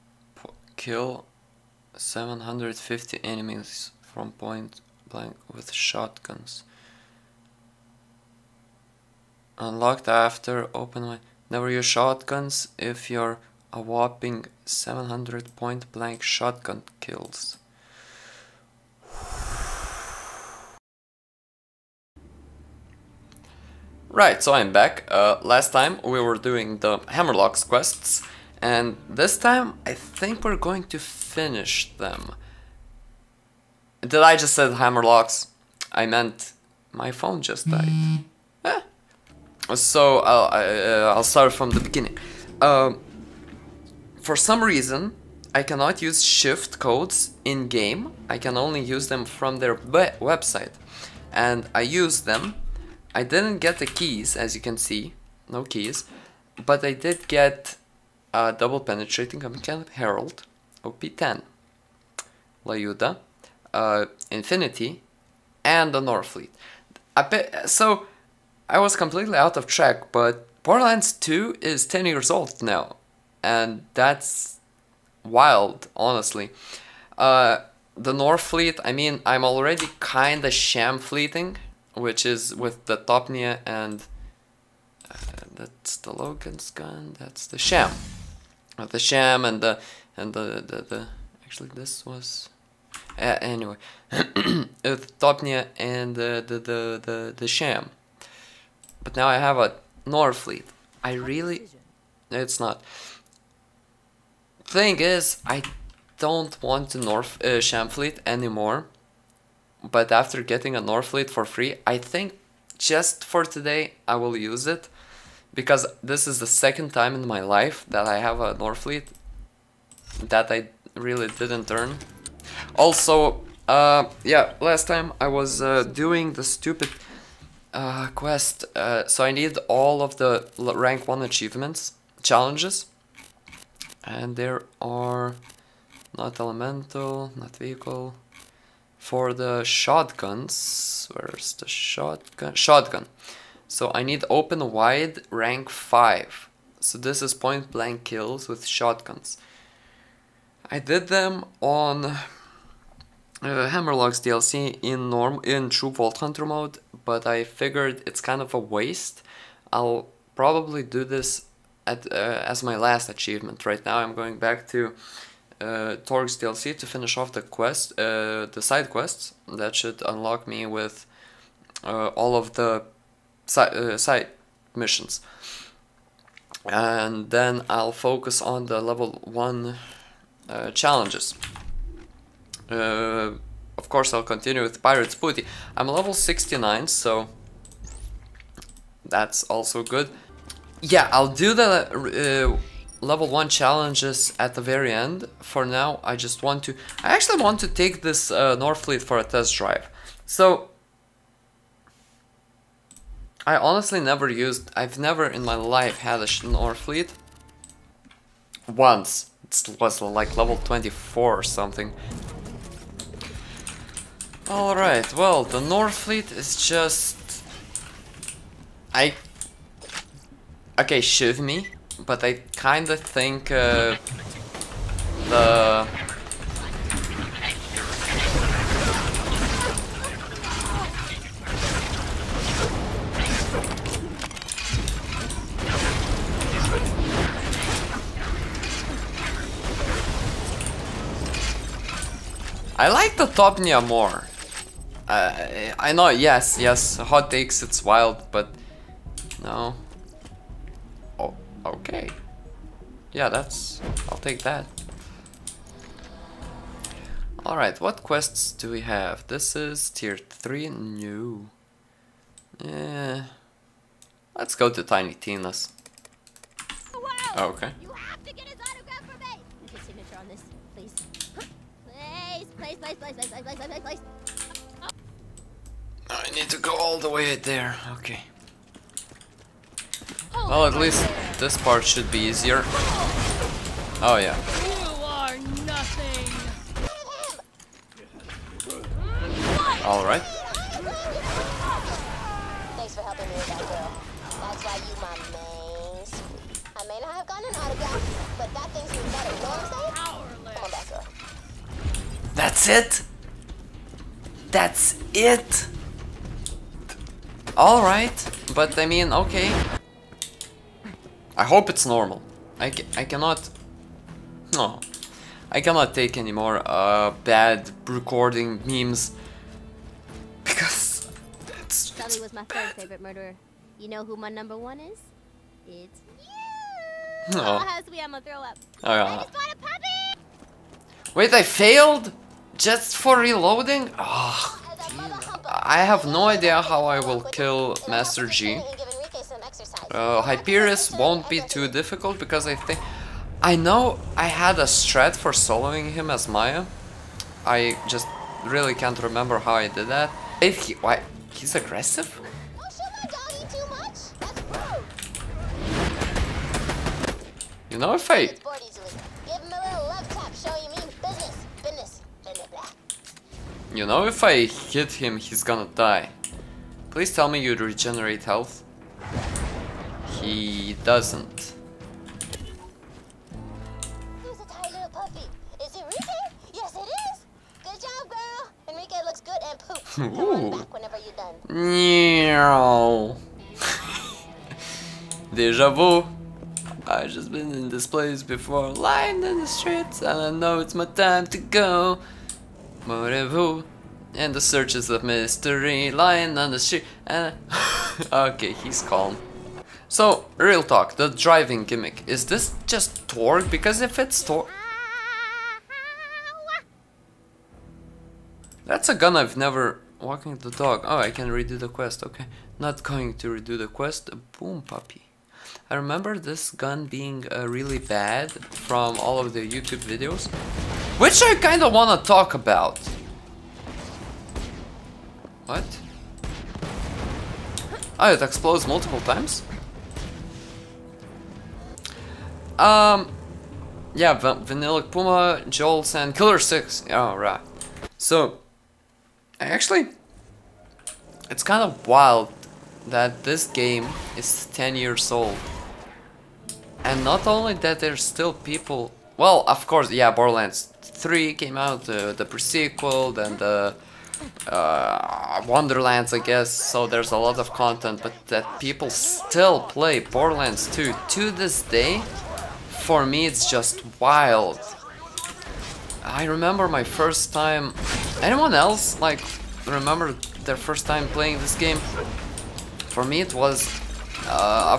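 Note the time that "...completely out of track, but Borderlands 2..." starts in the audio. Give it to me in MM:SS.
01:08.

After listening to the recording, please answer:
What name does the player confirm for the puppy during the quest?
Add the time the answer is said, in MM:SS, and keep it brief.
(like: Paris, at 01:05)
Enrique, at 06:18.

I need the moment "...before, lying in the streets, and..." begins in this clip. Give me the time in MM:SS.
06:28.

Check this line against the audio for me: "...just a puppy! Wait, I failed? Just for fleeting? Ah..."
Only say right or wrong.
wrong.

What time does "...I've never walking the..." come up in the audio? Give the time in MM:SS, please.
06:49.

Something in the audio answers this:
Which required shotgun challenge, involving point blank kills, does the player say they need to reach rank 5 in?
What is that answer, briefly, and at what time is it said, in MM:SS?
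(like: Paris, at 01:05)
Open Wide, at 02:24.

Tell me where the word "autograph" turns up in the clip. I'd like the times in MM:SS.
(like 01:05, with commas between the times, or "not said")
04:28, 04:57.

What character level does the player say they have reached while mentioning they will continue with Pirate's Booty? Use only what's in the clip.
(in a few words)
69.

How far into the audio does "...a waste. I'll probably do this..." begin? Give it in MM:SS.
02:38.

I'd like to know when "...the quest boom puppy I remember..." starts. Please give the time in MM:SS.
06:53.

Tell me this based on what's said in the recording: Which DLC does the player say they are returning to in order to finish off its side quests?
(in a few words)
Torgue DLC.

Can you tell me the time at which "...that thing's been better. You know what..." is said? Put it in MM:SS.
04:58.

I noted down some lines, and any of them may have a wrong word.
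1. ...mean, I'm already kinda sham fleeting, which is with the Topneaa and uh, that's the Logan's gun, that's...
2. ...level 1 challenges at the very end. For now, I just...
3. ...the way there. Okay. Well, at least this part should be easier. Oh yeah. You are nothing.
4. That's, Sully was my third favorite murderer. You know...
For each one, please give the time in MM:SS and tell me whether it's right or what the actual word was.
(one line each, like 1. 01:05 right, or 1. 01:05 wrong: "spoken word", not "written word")
1. 01:18 right
2. 03:13 right
3. 04:36 right
4. 05:21 right.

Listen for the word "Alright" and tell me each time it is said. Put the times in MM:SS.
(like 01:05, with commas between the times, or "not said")
03:34, 04:17, 05:07.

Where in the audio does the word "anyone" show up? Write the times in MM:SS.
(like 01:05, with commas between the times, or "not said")
07:48.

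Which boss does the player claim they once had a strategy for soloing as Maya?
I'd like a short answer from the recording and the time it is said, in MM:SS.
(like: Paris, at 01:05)
Hyperius, at 05:40.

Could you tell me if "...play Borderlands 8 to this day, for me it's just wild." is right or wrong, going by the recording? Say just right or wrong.
wrong.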